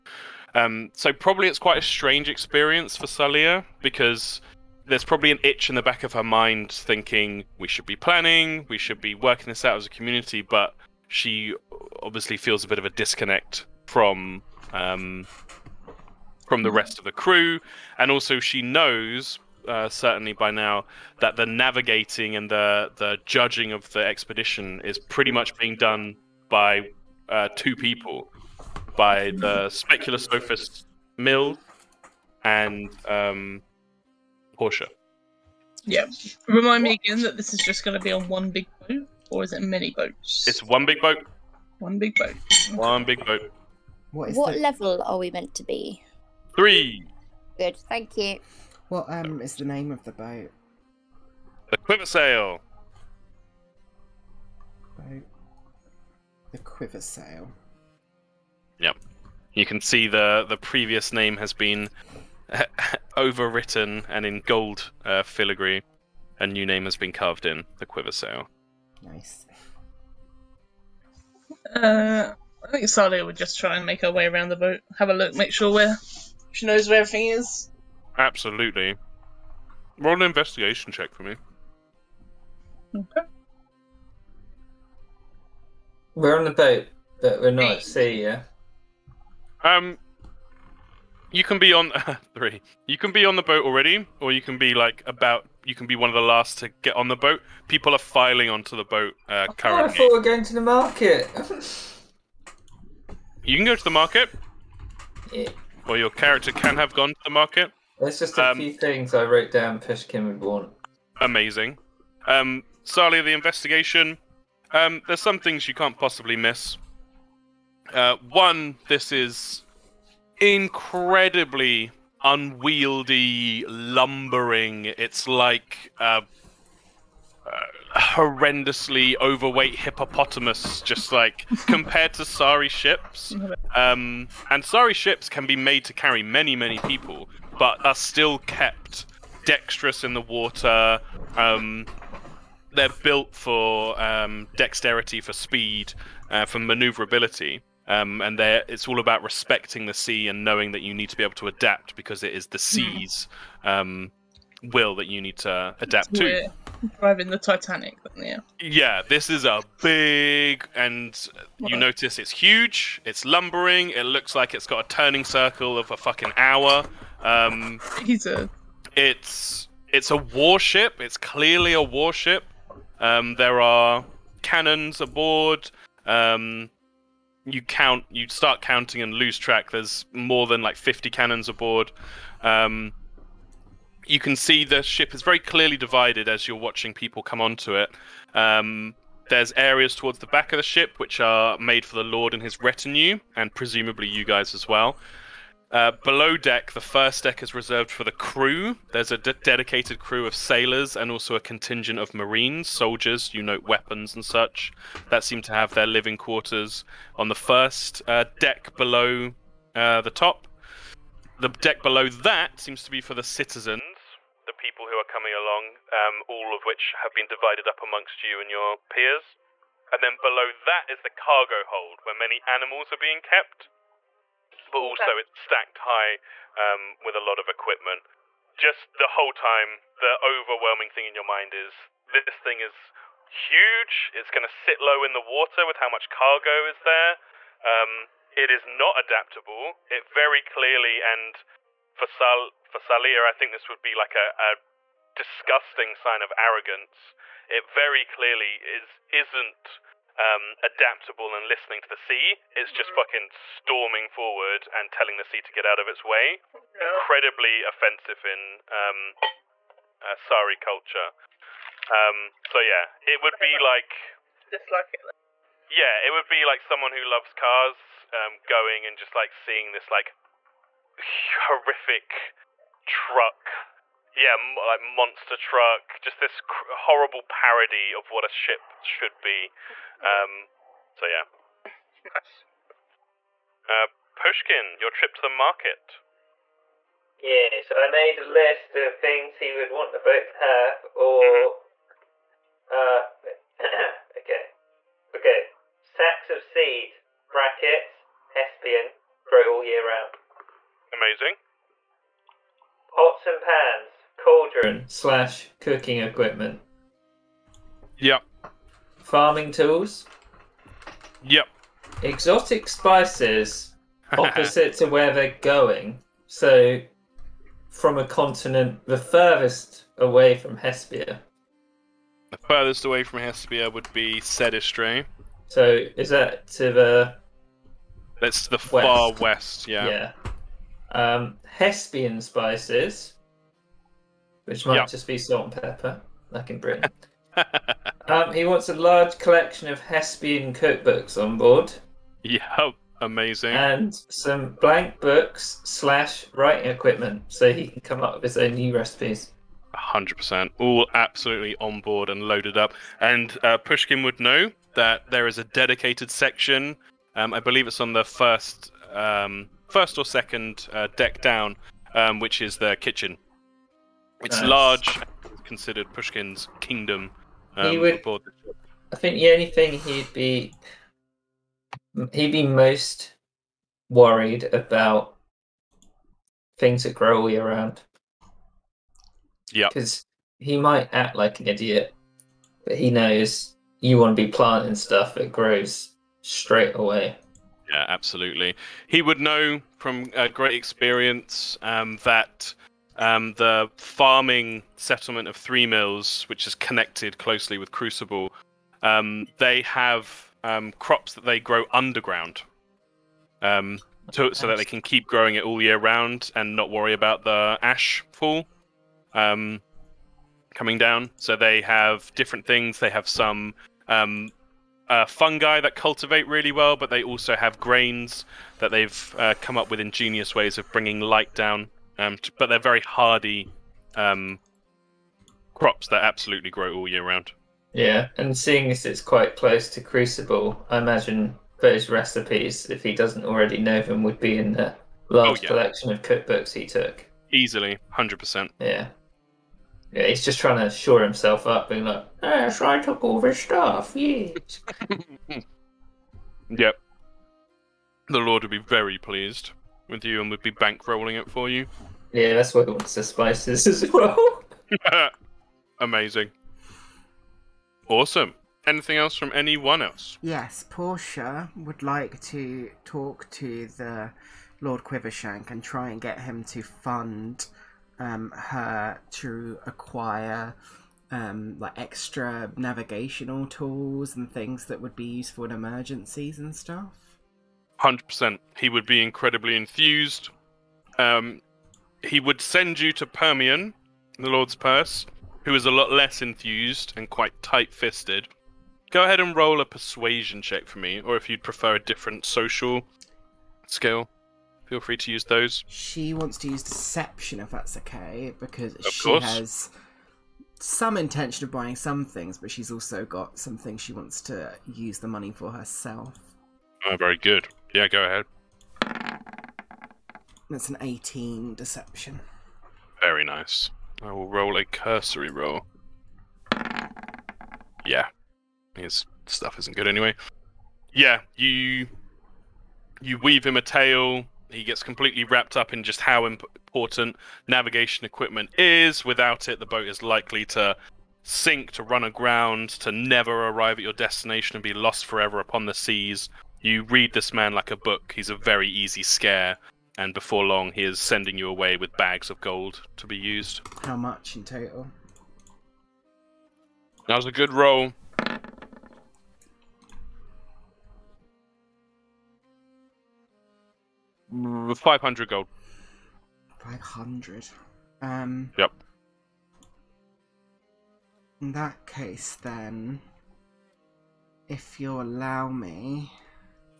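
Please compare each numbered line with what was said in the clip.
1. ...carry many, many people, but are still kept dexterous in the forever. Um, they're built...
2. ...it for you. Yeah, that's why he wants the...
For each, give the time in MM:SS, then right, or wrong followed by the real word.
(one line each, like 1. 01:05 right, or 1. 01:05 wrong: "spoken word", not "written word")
1. 02:15 wrong: "water", not "forever"
2. 07:31 right.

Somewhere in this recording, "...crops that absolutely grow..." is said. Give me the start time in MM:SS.
07:05.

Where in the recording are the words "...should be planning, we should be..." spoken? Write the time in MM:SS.
00:07.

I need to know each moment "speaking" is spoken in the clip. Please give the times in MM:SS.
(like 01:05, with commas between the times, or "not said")
not said.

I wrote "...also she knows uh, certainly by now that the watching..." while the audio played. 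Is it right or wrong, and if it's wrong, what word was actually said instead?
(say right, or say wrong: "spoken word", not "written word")
wrong: "navigating", not "watching".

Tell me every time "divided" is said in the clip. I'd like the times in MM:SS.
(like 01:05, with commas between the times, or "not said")
03:05, 03:37.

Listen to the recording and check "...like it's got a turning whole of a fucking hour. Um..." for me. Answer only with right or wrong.
wrong.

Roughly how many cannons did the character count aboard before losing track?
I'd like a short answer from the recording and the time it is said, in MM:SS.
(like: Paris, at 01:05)
More than 50, at 03:00.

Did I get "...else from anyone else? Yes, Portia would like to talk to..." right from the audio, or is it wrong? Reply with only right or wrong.
right.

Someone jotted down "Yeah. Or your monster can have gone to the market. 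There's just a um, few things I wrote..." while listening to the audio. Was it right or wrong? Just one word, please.
wrong.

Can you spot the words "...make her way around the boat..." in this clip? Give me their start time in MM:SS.
01:13.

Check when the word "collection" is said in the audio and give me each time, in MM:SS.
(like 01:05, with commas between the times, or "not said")
05:39, 07:15.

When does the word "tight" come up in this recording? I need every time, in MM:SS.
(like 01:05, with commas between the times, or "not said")
08:07.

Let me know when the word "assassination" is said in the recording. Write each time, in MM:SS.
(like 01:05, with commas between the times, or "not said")
not said.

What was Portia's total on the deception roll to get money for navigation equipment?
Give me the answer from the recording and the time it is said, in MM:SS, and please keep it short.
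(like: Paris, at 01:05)
18, at 08:30.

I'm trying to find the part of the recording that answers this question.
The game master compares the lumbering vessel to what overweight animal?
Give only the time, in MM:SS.
02:09.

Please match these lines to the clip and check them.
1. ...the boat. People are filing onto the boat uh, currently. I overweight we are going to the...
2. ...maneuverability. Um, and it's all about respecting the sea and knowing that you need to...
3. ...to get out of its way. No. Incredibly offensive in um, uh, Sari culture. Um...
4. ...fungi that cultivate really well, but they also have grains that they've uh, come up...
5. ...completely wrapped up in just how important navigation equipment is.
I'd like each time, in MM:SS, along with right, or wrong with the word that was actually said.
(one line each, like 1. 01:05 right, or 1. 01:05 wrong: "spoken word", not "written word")
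1. 01:37 wrong: "thought", not "overweight"
2. 02:26 right
3. 04:15 right
4. 06:55 right
5. 08:44 right.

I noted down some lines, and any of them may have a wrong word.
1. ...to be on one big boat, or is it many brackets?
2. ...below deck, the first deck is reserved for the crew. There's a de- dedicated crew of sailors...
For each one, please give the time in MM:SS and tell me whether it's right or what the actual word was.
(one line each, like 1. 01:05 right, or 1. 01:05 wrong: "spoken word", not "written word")
1. 00:37 wrong: "boats", not "brackets"
2. 03:16 right.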